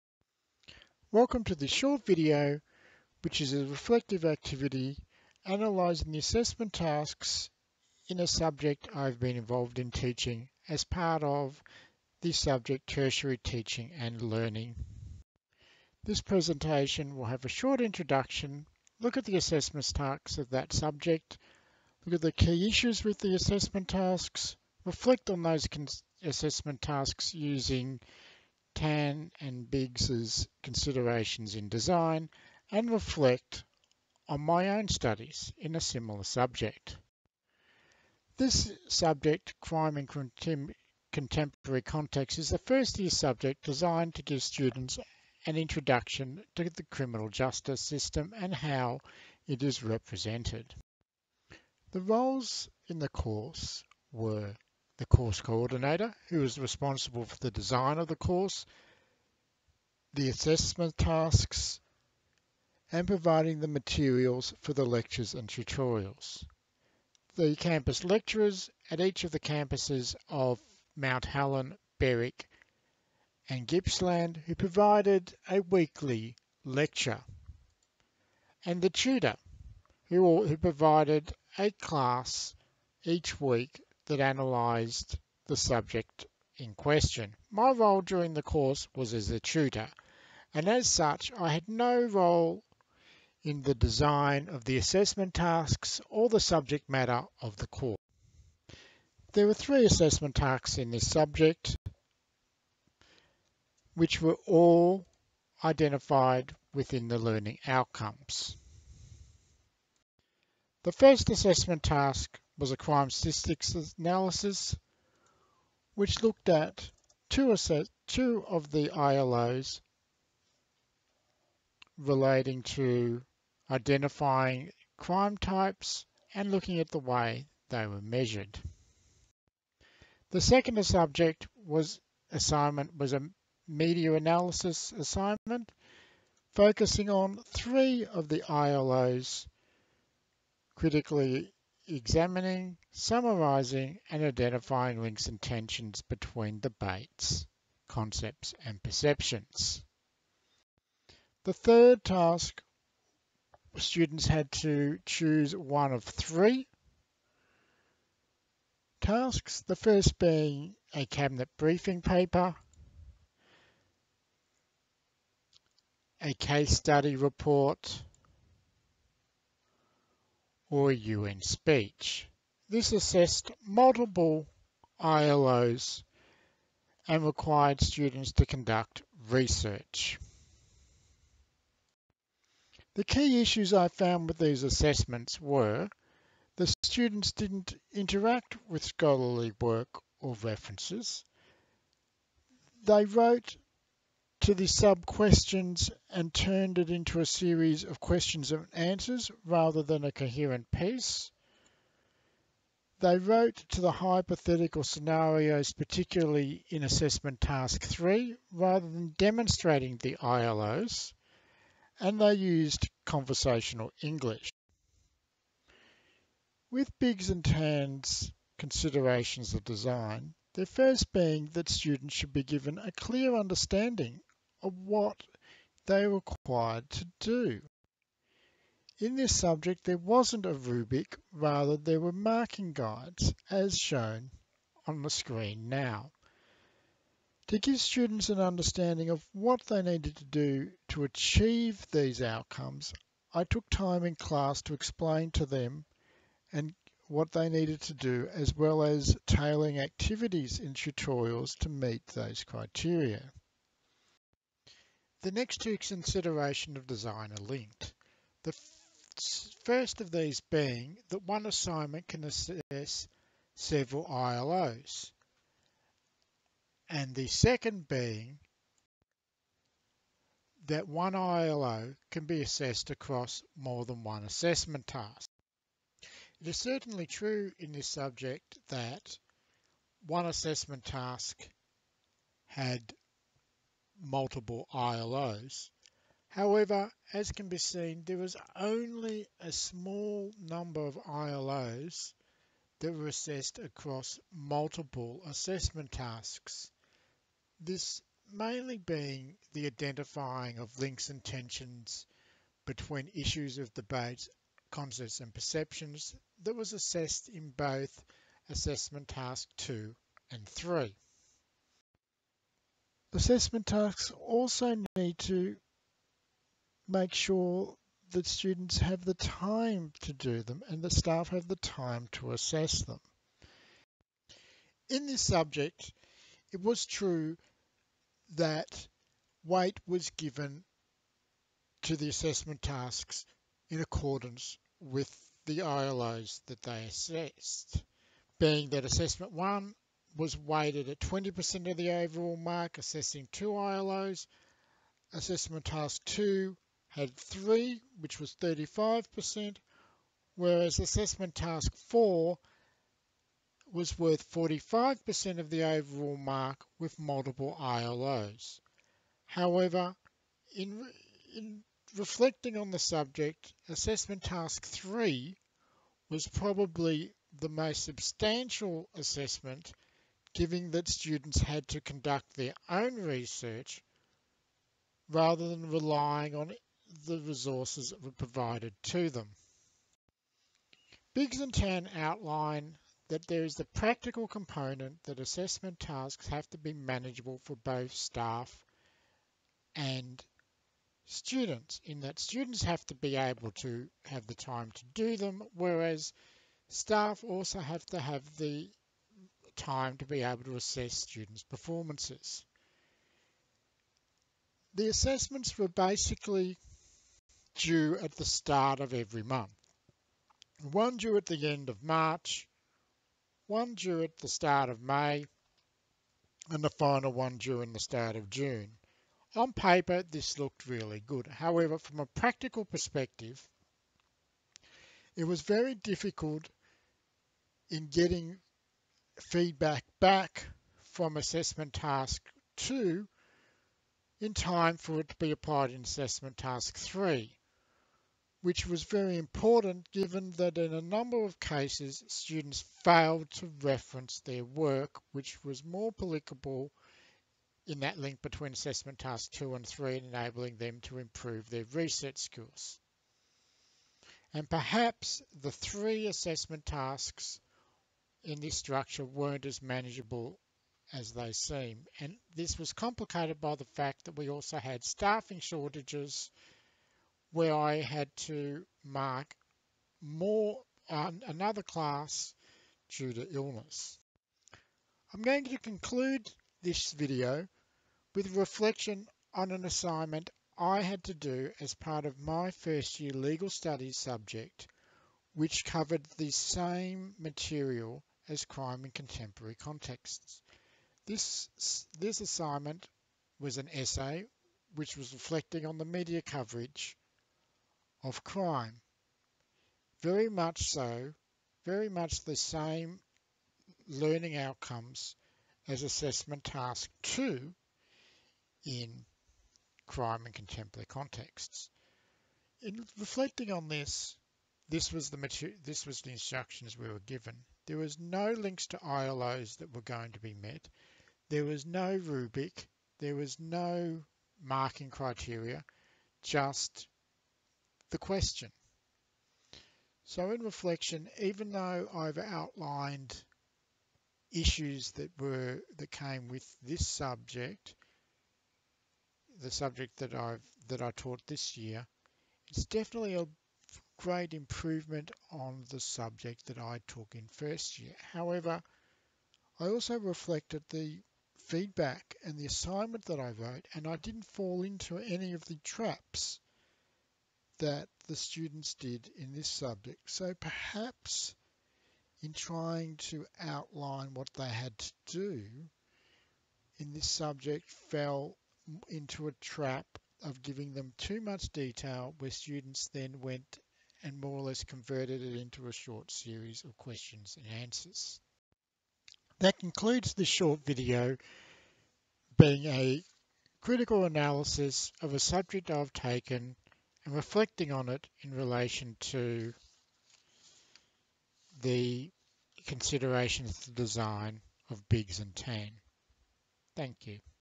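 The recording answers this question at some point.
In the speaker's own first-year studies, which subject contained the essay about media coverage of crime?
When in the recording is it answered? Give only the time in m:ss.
8:03.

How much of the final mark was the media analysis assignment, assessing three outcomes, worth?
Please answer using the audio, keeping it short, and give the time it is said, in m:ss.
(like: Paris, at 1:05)
35%, at 5:48.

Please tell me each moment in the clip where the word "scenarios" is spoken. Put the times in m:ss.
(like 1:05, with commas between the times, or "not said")
3:24.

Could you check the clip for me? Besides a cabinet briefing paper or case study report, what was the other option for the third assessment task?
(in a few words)
UN speech.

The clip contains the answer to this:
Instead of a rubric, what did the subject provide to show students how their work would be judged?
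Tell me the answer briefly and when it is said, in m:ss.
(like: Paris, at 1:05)
Marking guides, at 3:52.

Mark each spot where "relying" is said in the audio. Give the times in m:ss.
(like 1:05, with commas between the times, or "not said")
6:15.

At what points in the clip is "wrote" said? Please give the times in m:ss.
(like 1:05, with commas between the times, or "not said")
3:13, 3:23, 9:13.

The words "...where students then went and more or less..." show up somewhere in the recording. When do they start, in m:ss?
9:32.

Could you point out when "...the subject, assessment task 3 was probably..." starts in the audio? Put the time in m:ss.
6:02.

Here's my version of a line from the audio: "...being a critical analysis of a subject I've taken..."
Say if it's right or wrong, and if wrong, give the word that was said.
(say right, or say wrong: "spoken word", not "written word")
right.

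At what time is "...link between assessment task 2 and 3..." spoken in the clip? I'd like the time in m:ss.
7:27.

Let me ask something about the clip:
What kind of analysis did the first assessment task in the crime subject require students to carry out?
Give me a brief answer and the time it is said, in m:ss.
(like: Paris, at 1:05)
Crime statistics analysis, at 1:52.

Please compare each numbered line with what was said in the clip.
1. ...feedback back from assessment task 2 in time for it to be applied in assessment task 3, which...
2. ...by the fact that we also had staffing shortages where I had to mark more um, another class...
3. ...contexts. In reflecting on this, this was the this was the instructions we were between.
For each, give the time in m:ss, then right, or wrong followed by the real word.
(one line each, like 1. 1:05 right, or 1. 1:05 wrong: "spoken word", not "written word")
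1. 7:09 right
2. 7:43 right
3. 8:30 wrong: "given", not "between".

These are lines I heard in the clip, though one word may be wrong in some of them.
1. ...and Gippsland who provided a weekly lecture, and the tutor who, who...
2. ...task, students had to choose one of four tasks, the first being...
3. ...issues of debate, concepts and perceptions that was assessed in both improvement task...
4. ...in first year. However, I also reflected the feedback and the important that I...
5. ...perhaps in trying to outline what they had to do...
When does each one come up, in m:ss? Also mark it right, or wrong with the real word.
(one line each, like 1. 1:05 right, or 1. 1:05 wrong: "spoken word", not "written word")
1. 1:13 right
2. 2:32 wrong: "three", not "four"
3. 5:03 wrong: "assessment", not "improvement"
4. 9:07 wrong: "assignment", not "important"
5. 9:20 right.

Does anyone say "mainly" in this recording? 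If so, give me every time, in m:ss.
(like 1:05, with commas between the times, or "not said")
4:58.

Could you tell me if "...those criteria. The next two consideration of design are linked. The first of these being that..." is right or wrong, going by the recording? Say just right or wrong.
right.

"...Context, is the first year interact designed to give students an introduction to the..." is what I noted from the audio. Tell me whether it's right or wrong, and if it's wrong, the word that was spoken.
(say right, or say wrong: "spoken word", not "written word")
wrong: "subject", not "interact".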